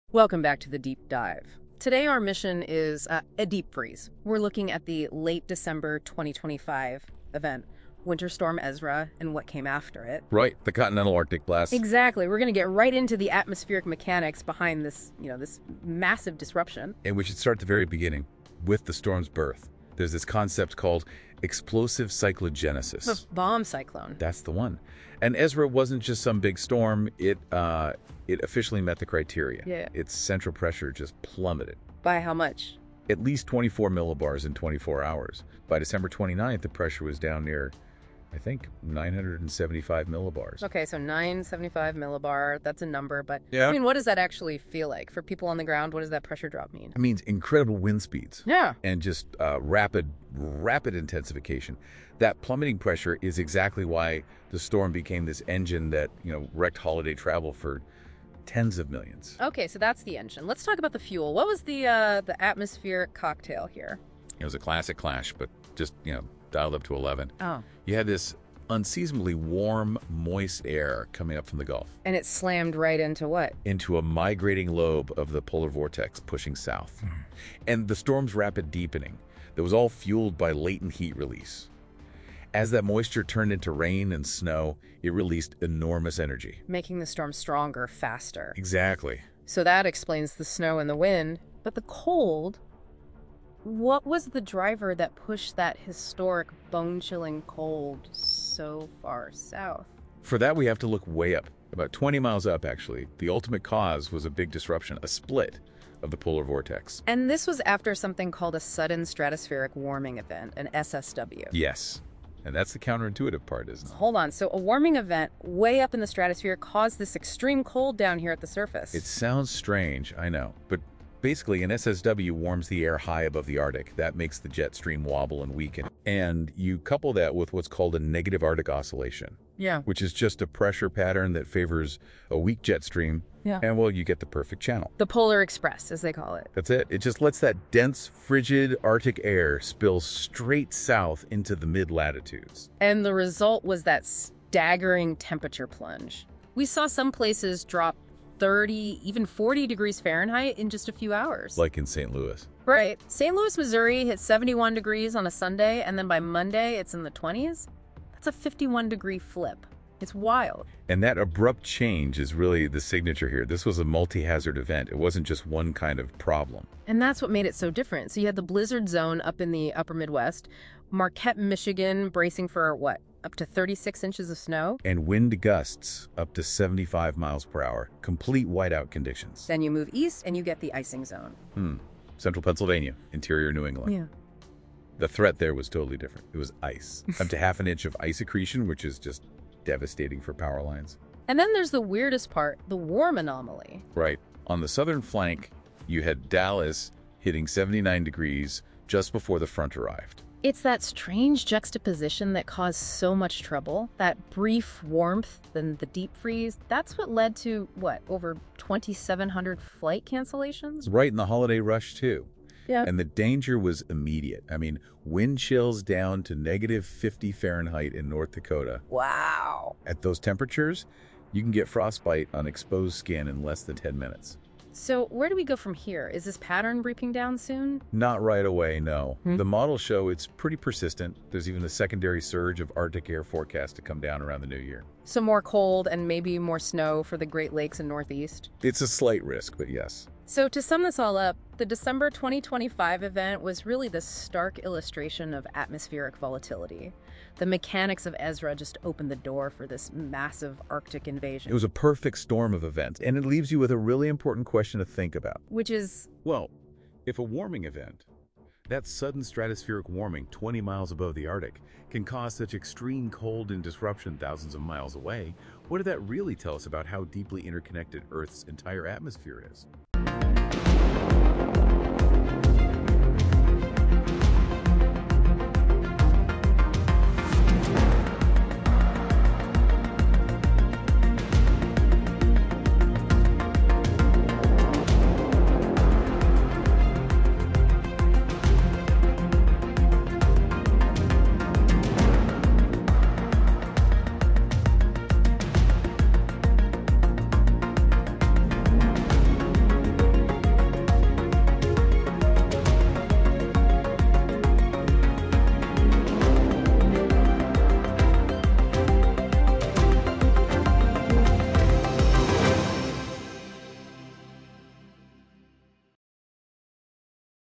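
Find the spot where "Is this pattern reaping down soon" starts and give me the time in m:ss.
3:46.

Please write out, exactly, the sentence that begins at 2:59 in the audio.
Then you move east and you get the icing zone.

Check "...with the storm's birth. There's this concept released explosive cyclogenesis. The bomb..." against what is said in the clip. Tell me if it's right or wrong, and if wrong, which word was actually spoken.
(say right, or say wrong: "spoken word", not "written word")
wrong: "called", not "released".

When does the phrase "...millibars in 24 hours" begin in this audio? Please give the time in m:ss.
0:33.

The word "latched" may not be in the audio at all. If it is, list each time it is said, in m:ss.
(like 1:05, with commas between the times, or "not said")
not said.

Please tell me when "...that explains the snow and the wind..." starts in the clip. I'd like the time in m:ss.
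1:29.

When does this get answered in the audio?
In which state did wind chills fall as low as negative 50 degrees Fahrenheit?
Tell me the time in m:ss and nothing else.
3:38.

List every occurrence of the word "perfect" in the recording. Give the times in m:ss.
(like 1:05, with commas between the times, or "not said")
2:14, 4:11.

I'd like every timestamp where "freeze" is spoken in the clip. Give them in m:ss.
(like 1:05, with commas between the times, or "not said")
0:03, 3:26.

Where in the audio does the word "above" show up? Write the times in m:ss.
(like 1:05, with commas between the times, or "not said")
2:03, 4:20.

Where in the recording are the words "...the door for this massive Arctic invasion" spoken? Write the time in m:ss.
4:09.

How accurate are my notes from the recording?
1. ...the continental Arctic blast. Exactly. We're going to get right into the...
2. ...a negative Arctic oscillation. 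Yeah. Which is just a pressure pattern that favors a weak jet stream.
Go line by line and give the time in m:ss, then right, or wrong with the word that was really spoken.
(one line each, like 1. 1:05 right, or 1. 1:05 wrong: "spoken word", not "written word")
1. 0:10 right
2. 2:07 right.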